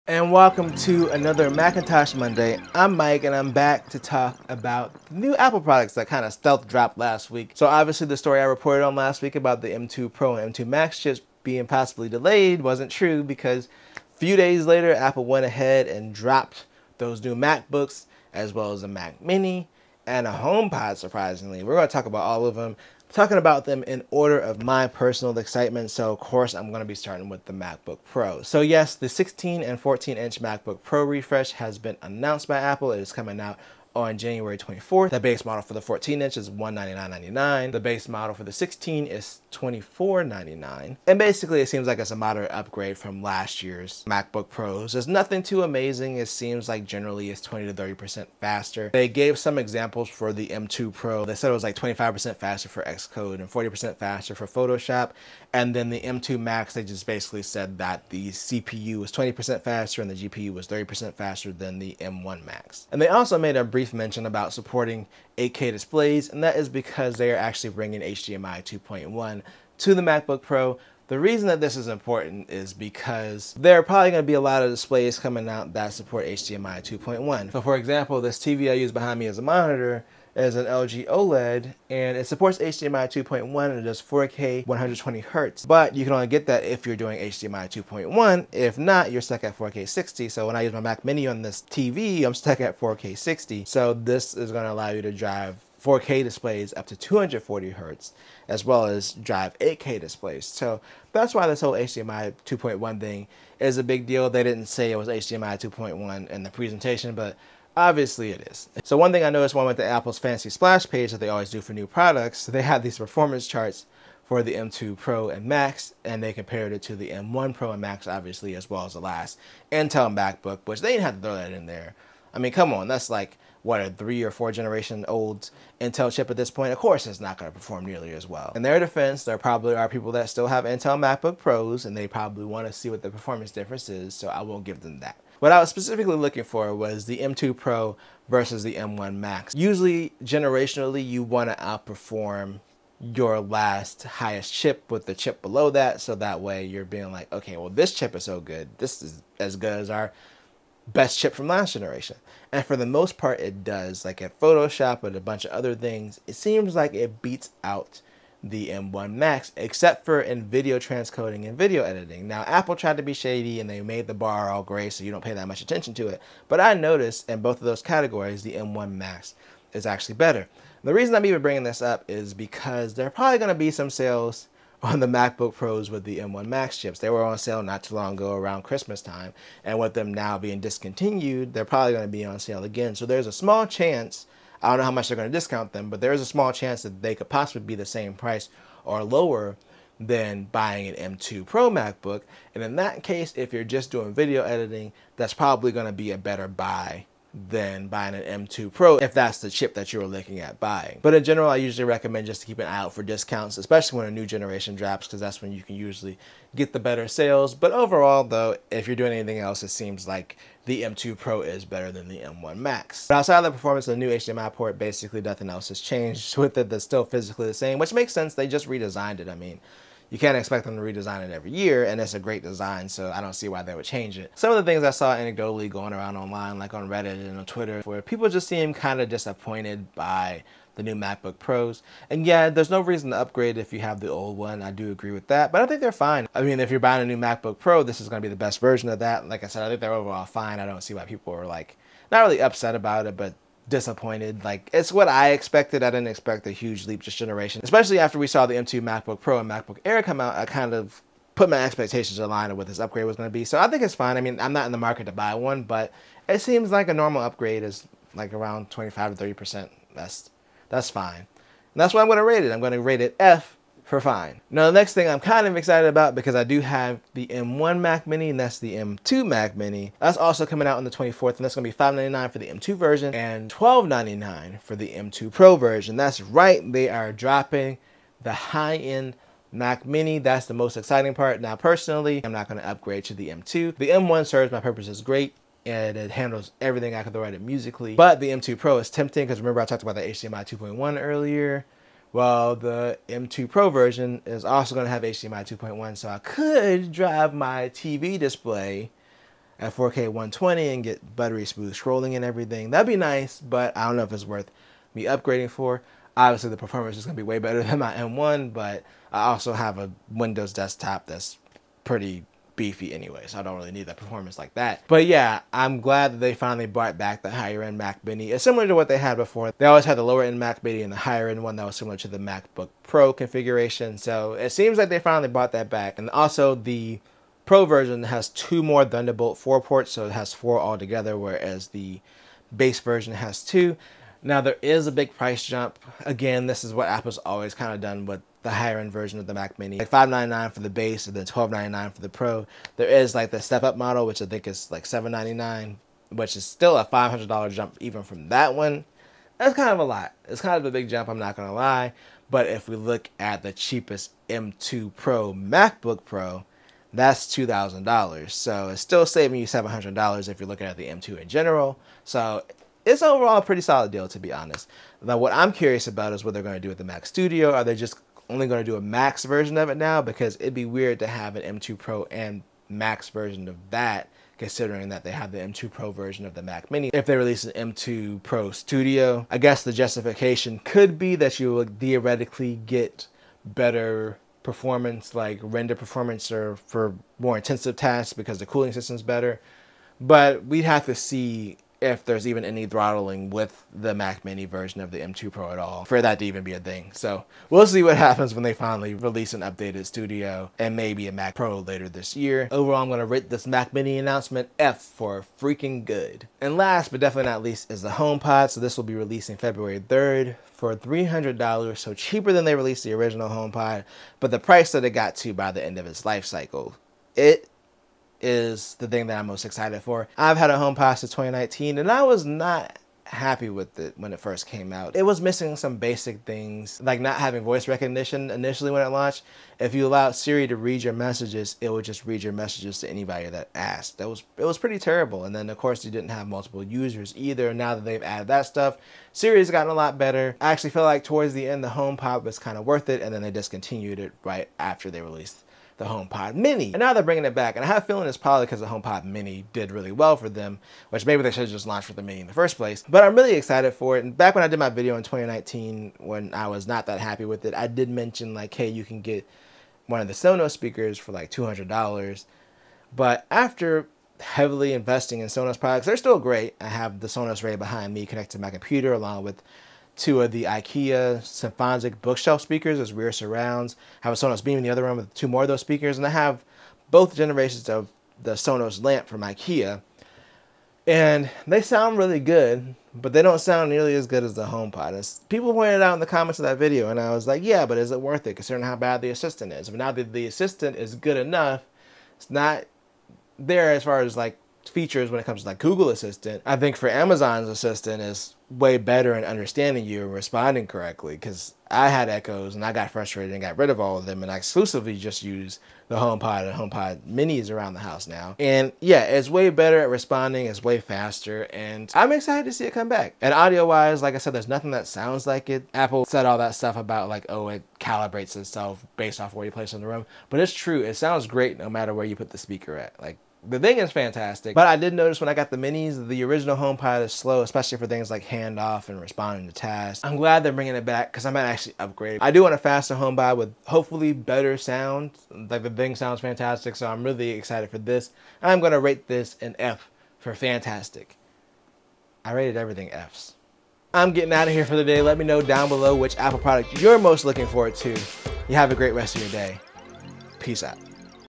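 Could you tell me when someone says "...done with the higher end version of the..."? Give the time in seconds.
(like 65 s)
337 s.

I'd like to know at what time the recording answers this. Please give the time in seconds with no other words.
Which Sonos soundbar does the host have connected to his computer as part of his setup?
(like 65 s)
467 s.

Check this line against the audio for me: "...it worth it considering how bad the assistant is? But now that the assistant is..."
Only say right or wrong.
right.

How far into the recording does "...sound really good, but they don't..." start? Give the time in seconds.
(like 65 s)
481 s.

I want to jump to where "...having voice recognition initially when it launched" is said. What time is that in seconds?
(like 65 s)
427 s.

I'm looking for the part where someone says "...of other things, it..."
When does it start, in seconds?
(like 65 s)
155 s.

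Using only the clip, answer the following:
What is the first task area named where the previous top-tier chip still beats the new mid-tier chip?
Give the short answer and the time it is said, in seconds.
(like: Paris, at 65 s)
video transcoding, at 160 s.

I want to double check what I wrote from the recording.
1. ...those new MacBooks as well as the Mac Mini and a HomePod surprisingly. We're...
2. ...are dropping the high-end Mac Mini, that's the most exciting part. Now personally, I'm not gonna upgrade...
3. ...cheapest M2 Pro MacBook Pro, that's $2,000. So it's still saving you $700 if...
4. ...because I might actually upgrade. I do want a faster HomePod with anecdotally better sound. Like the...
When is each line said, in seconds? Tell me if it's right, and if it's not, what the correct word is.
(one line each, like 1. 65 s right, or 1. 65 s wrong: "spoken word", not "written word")
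1. 16 s right
2. 276 s right
3. 353 s right
4. 531 s wrong: "hopefully", not "anecdotally".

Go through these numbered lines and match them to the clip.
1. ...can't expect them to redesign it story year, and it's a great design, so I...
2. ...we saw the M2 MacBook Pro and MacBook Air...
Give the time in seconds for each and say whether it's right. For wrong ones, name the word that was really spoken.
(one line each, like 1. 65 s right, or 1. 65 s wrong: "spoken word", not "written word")
1. 220 s wrong: "every", not "story"
2. 248 s right.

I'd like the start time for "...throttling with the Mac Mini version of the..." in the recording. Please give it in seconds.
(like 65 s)
392 s.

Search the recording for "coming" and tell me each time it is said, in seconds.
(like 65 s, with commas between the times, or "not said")
33 s, 75 s, 270 s.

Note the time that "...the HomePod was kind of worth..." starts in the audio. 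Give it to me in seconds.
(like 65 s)
441 s.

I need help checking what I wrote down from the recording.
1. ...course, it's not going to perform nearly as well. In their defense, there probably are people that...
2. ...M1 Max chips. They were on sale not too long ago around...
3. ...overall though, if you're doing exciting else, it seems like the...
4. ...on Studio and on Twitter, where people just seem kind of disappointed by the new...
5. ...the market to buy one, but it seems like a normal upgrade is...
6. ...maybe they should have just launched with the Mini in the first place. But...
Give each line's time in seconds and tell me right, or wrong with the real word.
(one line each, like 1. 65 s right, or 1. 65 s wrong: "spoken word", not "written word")
1. 126 s right
2. 176 s right
3. 207 s wrong: "anything", not "exciting"
4. 226 s wrong: "Reddit", not "Studio"
5. 254 s right
6. 451 s right.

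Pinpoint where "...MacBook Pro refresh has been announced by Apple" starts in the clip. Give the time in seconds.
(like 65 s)
30 s.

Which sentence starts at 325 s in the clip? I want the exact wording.
And also the Pro version has two more Thunderbolt 4 ports, so it has four altogether, whereas the base version has two.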